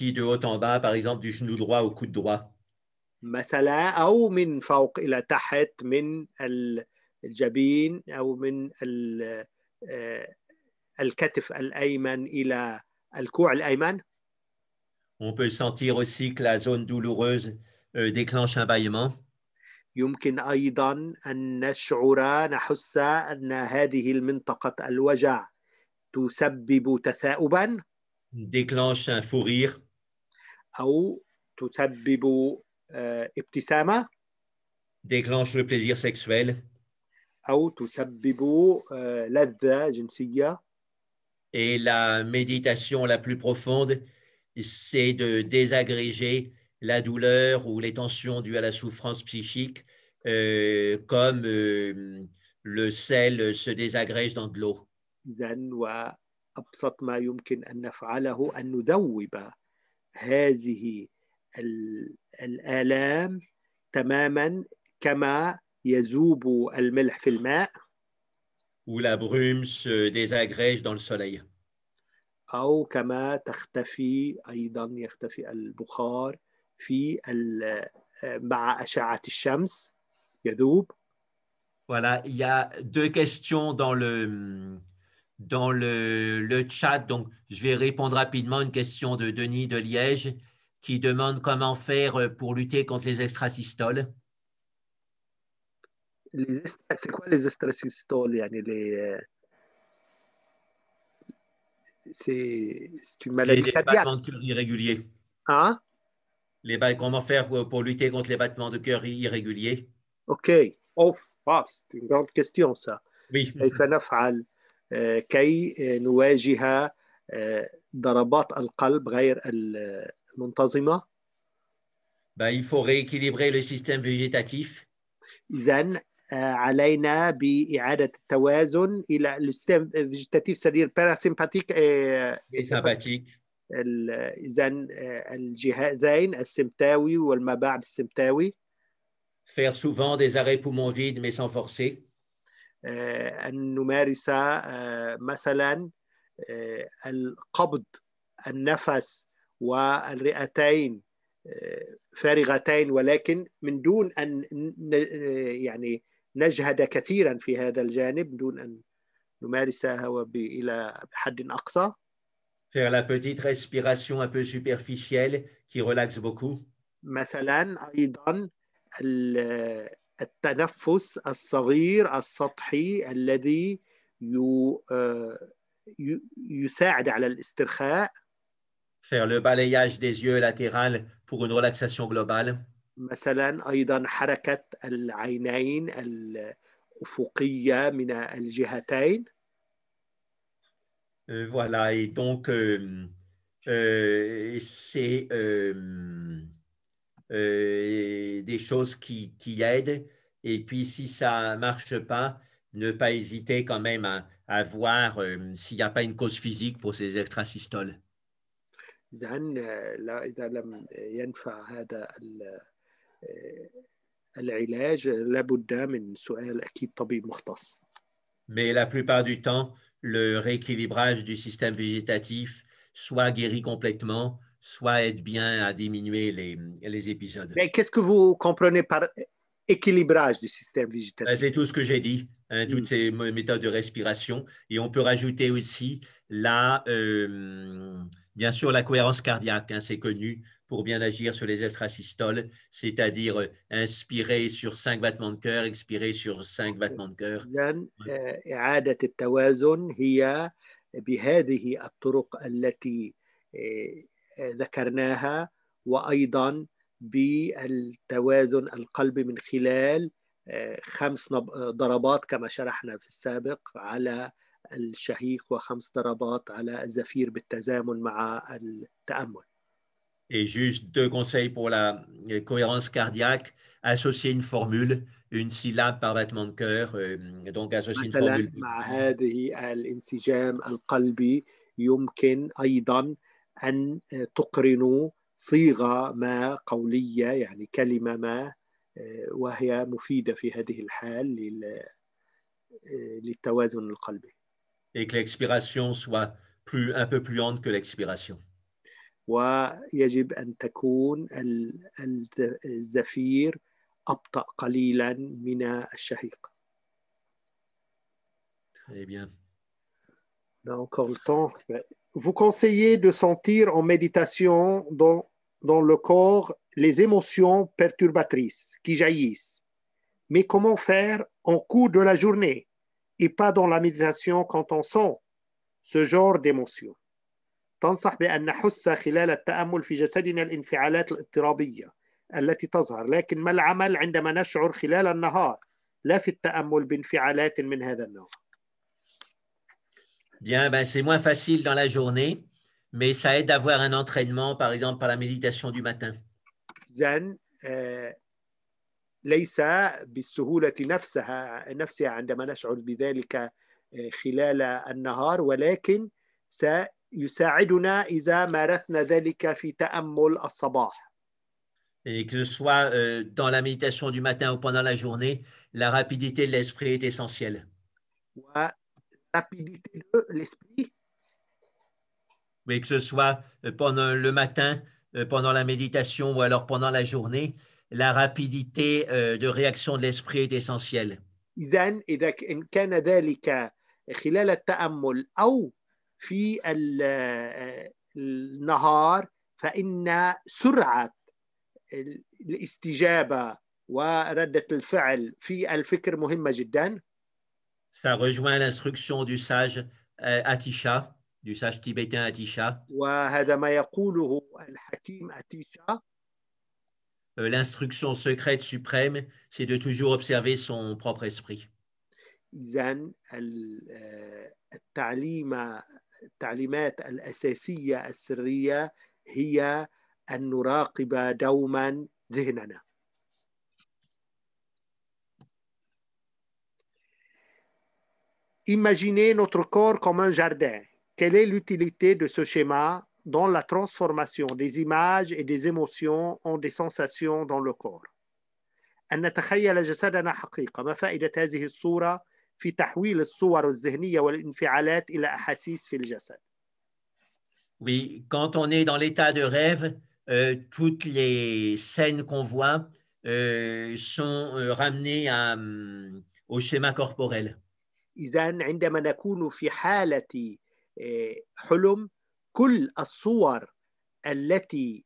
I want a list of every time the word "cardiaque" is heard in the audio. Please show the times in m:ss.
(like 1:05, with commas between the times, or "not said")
3:59, 4:32.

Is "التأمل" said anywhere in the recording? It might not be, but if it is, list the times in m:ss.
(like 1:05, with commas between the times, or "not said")
4:28, 5:29, 5:36.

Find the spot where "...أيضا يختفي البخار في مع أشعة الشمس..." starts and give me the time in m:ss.
1:14.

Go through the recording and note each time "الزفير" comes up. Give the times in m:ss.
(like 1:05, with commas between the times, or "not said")
4:26, 5:02.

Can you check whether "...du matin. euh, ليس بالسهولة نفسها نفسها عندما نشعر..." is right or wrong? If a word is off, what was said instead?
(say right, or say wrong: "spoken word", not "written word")
right.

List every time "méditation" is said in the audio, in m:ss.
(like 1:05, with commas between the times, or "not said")
0:42, 5:13, 5:23, 5:45, 6:03, 6:15.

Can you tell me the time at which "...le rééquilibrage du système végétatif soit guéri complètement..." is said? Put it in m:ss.
3:39.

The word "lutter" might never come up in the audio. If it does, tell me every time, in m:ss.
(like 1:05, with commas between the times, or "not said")
1:32, 1:47.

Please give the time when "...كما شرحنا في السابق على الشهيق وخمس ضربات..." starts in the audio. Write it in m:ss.
4:22.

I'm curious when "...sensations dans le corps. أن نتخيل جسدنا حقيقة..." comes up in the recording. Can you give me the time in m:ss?
7:16.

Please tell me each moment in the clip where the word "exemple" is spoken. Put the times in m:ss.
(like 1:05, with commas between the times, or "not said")
0:00, 5:44.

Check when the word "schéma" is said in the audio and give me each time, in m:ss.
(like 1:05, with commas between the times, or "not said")
7:12, 7:36.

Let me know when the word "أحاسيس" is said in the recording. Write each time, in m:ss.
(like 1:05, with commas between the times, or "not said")
7:25.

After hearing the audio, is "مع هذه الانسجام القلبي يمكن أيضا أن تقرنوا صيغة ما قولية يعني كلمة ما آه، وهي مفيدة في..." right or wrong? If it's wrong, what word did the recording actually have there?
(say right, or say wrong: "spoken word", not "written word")
right.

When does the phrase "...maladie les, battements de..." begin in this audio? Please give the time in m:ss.
1:43.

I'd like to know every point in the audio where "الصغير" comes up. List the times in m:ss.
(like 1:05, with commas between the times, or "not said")
2:51.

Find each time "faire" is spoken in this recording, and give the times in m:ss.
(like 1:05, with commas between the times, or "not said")
1:31, 1:47, 2:19, 2:42, 2:59, 5:20.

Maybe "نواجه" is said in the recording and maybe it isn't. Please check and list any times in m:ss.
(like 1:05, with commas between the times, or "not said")
1:55.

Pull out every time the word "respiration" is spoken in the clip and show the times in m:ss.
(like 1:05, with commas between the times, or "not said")
2:43, 3:53.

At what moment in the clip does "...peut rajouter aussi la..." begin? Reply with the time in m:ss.
3:54.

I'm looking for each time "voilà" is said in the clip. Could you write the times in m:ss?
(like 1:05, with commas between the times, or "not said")
1:21, 3:11.